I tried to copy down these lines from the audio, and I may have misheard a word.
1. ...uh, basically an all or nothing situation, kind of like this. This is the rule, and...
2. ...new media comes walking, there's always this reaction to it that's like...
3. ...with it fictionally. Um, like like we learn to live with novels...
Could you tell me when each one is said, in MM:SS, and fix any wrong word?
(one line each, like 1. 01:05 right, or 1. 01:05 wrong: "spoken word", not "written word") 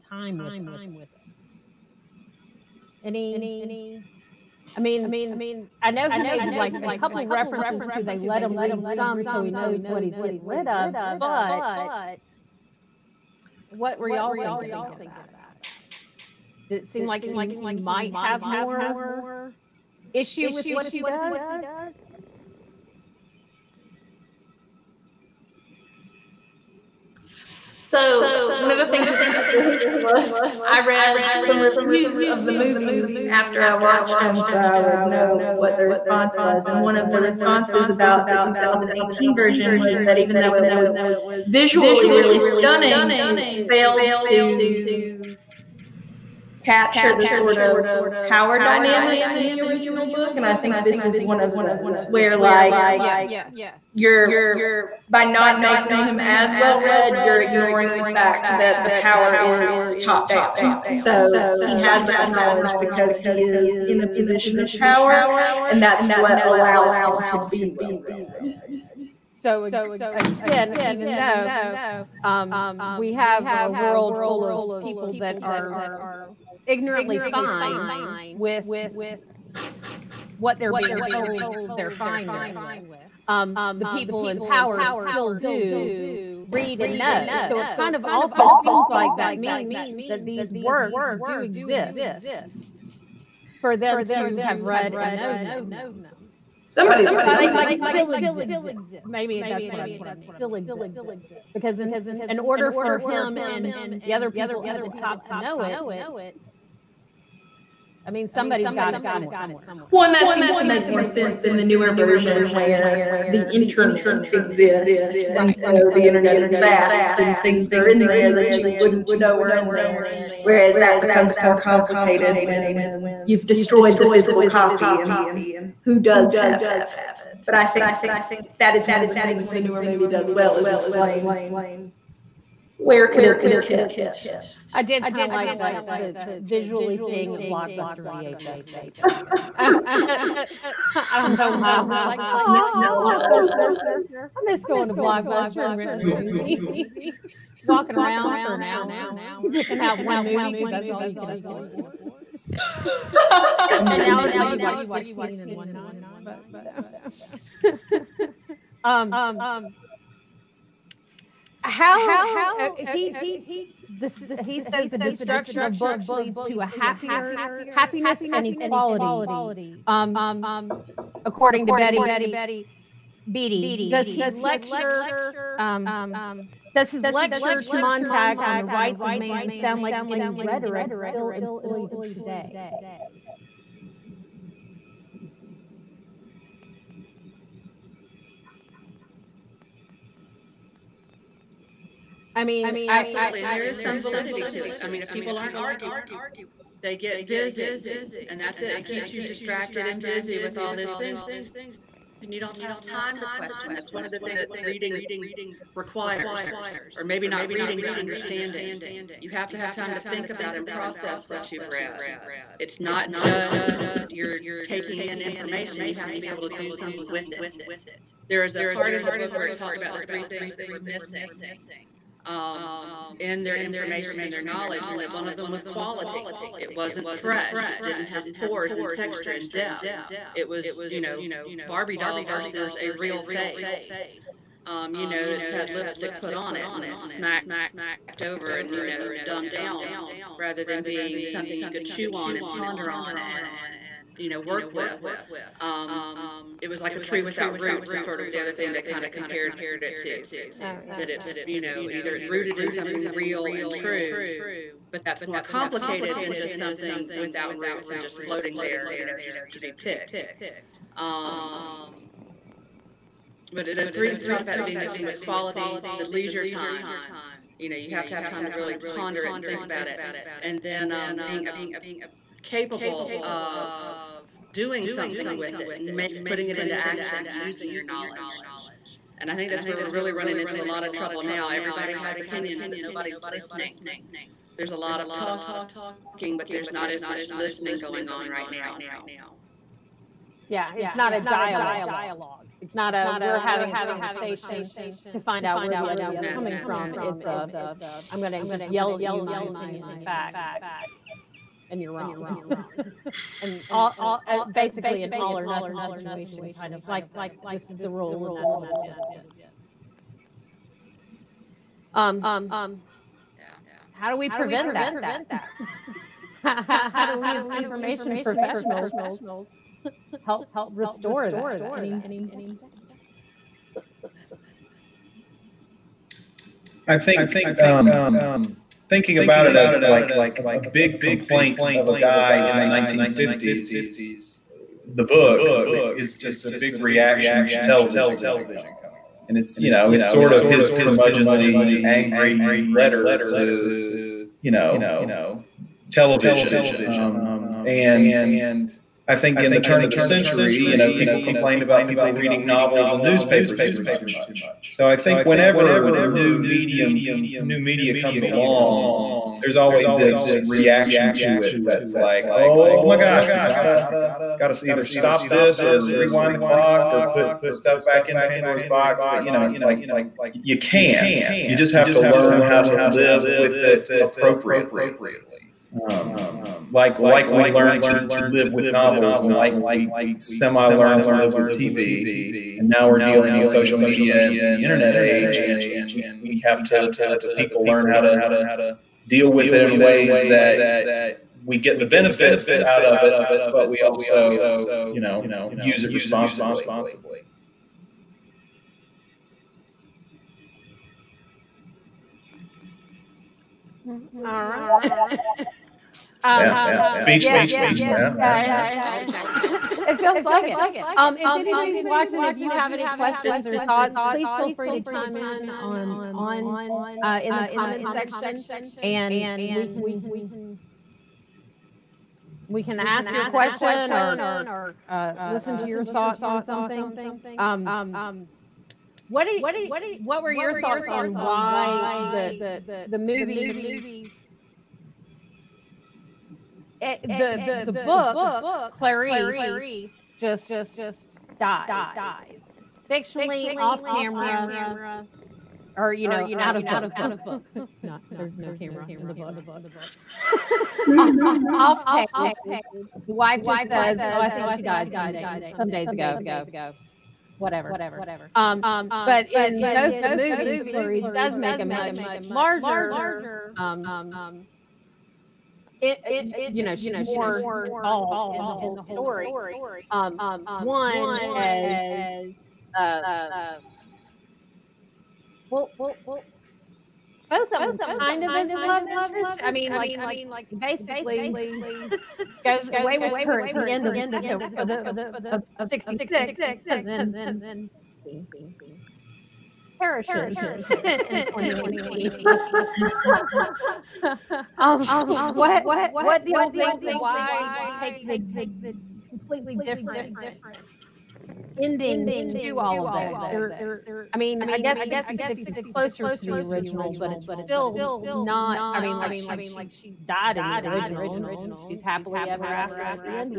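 1. 05:04 right
2. 05:57 wrong: "along", not "walking"
3. 06:13 wrong: "appropriately", not "fictionally".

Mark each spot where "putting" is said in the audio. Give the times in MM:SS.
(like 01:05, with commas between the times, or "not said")
04:36.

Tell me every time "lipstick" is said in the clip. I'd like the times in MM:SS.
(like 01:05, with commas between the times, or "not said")
03:55.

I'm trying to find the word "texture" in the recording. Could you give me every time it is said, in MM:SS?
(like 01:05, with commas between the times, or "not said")
03:48.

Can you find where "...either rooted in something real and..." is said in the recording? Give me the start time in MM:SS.
04:11.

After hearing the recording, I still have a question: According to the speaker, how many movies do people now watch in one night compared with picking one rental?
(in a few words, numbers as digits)
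15.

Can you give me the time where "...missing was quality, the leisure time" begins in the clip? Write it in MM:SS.
04:24.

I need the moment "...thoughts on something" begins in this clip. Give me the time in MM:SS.
07:05.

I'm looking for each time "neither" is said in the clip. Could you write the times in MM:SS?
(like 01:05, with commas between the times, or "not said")
not said.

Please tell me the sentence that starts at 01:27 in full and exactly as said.
So it kind of also seems like that means that these works do exist for them to have read and known them.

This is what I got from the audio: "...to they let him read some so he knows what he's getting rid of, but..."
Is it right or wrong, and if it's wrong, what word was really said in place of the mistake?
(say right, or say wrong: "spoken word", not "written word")
right.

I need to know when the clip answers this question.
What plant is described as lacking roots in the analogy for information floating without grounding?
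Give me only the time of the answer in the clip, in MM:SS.
04:06.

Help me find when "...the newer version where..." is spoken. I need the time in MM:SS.
01:51.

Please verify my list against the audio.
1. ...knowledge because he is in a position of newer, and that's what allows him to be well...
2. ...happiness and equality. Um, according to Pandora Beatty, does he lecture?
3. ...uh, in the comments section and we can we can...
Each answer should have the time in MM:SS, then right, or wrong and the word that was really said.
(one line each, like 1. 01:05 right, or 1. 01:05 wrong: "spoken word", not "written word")
1. 01:02 wrong: "power", not "newer"
2. 02:47 wrong: "Betty", not "Pandora"
3. 06:57 right.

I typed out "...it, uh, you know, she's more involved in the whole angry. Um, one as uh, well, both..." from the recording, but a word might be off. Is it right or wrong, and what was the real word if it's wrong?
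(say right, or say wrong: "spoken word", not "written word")
wrong: "story", not "angry".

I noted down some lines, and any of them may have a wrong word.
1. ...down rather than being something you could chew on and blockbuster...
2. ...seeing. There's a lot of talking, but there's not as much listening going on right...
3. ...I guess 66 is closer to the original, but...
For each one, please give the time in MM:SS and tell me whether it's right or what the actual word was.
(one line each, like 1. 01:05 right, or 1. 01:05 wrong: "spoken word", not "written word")
1. 03:59 wrong: "ponder", not "blockbuster"
2. 04:43 wrong: "listening", not "seeing"
3. 08:24 right.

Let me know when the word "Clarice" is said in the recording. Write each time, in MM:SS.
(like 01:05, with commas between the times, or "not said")
07:18, 07:40.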